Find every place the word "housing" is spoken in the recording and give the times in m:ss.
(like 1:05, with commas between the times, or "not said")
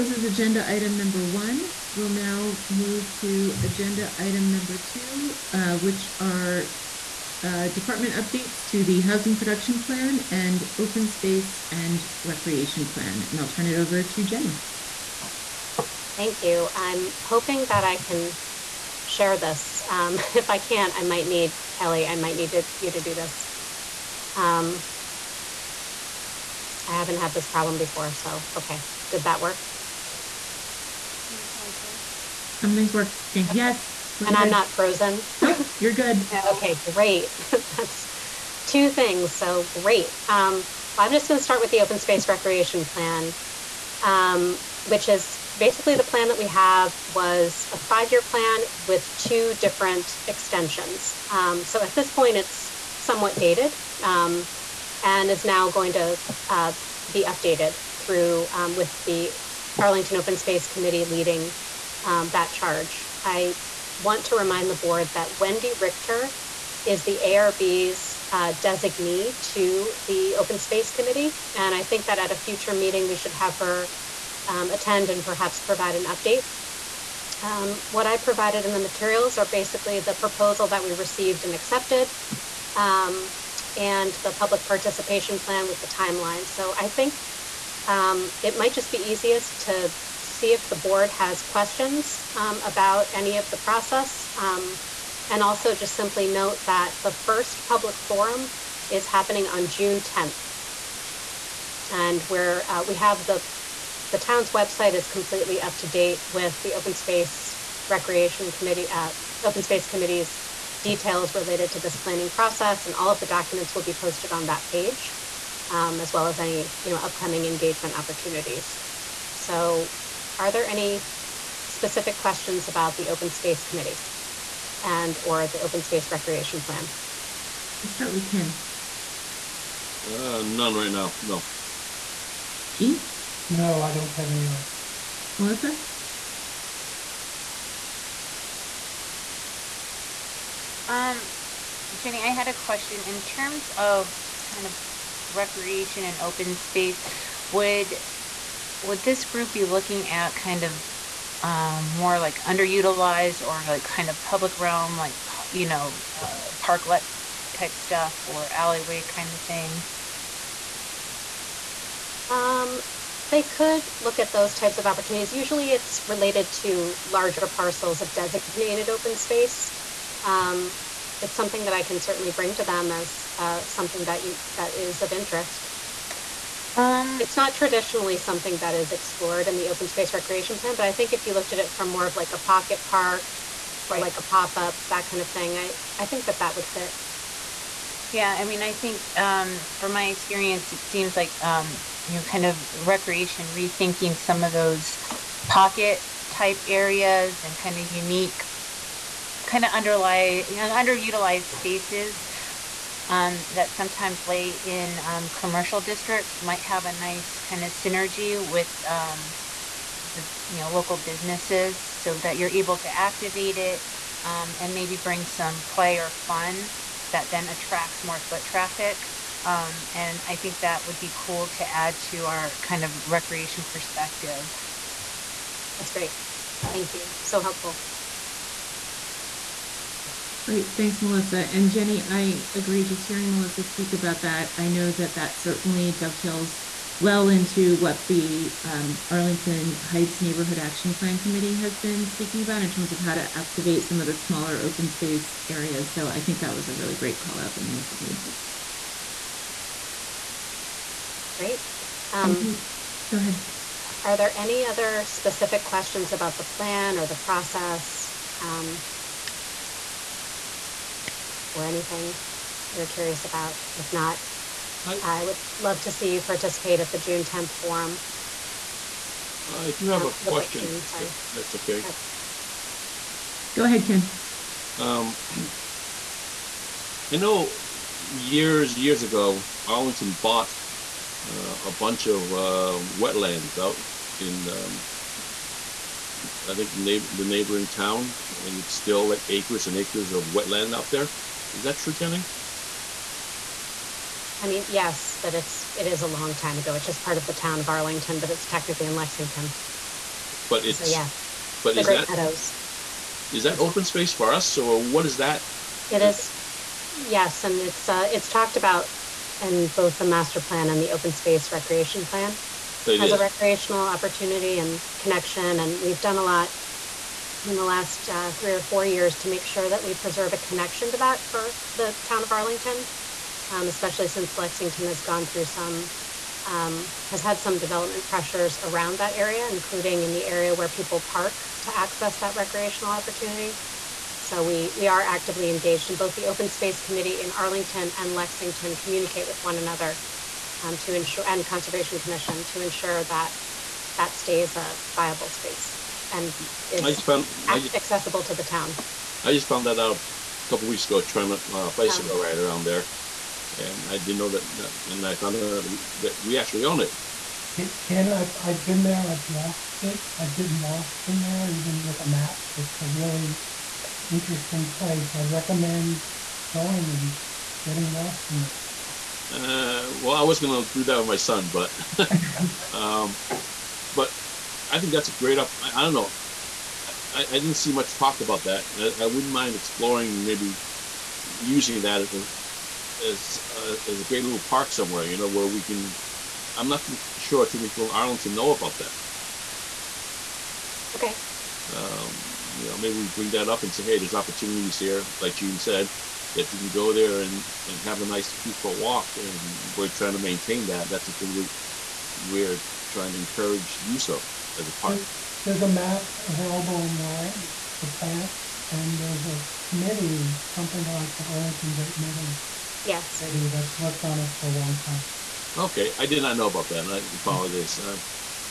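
0:09.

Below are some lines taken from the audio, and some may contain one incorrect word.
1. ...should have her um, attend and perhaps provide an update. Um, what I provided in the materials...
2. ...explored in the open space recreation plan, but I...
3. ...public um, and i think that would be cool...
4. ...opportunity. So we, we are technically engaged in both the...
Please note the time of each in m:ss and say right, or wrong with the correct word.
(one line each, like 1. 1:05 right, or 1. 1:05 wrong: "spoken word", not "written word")
1. 1:13 right
2. 2:58 right
3. 3:38 wrong: "traffic", not "public"
4. 5:32 wrong: "actively", not "technically".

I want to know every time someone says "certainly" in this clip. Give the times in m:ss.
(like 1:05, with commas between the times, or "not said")
2:52, 3:55.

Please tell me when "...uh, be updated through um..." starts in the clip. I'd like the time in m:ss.
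0:56.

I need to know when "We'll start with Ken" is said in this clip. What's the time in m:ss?
2:07.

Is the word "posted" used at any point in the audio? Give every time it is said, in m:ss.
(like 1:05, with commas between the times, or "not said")
1:53.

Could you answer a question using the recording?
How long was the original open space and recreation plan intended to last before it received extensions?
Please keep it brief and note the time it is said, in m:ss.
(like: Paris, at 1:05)
5 years, at 0:47.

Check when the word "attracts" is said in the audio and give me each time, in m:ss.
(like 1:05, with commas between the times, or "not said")
3:37.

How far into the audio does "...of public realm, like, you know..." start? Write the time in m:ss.
2:34.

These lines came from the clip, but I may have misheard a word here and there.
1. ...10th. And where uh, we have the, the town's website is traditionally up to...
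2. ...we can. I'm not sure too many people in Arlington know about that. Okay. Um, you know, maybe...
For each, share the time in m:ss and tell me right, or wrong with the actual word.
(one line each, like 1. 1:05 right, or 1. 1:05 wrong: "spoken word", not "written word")
1. 1:40 wrong: "completely", not "traditionally"
2. 6:25 right.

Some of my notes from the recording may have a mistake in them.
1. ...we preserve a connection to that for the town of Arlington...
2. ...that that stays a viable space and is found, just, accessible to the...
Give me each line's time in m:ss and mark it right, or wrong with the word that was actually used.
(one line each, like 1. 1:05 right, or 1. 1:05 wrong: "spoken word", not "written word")
1. 5:19 right
2. 5:43 right.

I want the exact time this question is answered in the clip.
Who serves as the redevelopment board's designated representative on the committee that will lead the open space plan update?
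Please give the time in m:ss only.
1:05.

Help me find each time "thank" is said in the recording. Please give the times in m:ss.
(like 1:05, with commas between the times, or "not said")
0:16, 3:46, 3:50.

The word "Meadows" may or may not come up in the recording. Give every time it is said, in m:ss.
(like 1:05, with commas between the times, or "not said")
5:02, 6:51.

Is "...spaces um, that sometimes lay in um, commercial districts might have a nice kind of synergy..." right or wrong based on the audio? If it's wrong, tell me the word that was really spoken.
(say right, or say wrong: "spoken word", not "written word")
right.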